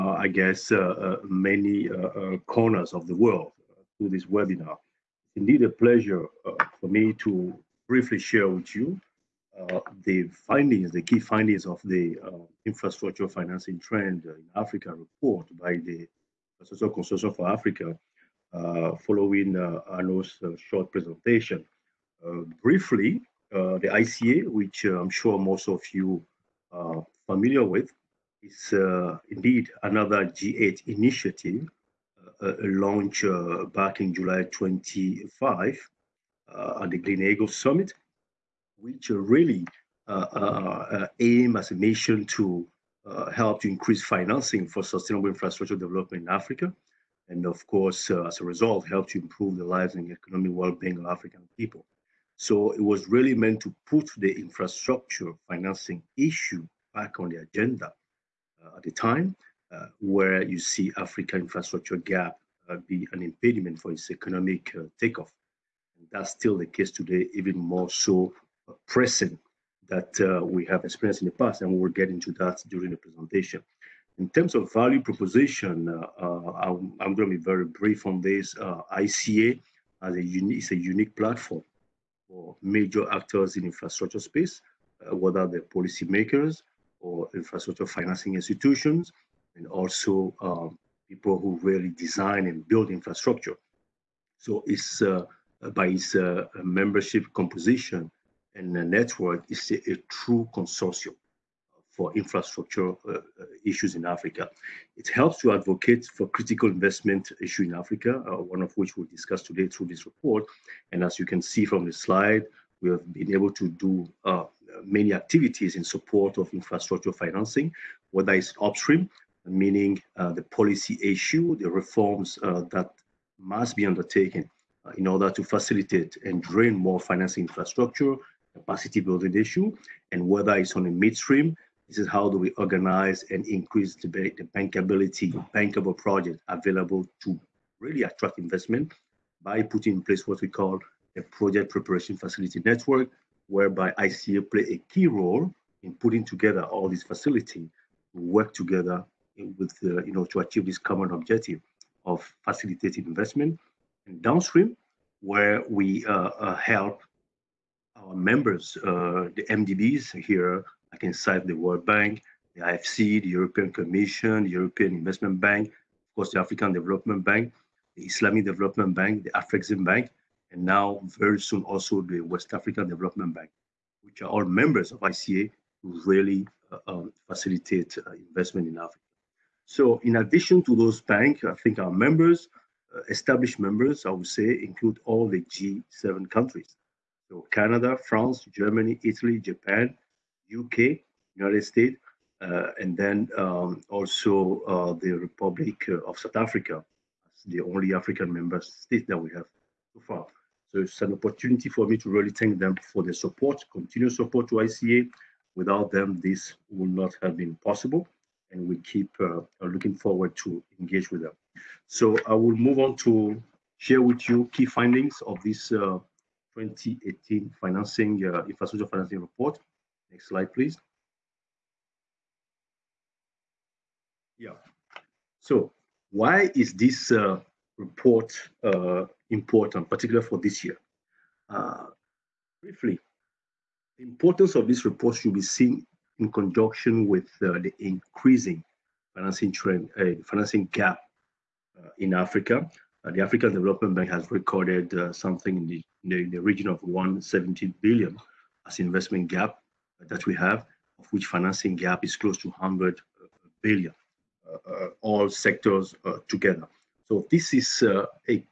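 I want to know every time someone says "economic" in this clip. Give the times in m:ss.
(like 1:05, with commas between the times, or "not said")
0:50, 1:04.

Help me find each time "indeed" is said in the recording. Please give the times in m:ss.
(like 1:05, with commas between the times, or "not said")
0:05, 0:29.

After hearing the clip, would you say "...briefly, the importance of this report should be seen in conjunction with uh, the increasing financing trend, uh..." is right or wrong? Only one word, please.
right.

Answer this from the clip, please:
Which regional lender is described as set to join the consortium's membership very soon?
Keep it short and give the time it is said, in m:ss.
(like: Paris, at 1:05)
West African Development Bank, at 2:52.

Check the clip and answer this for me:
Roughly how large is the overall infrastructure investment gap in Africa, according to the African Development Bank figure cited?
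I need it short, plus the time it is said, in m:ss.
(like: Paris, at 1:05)
170 billion, at 4:06.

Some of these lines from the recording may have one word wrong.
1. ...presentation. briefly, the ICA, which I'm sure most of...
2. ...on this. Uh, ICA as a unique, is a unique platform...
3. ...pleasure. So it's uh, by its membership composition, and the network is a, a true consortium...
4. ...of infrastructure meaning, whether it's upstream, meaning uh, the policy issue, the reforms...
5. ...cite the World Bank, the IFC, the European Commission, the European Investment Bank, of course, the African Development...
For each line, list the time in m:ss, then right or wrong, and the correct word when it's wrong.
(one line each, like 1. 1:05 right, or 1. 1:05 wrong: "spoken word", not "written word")
1. 0:20 right
2. 1:18 right
3. 1:32 wrong: "infrastructure", not "pleasure"
4. 1:56 wrong: "financing", not "meaning"
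5. 2:41 right.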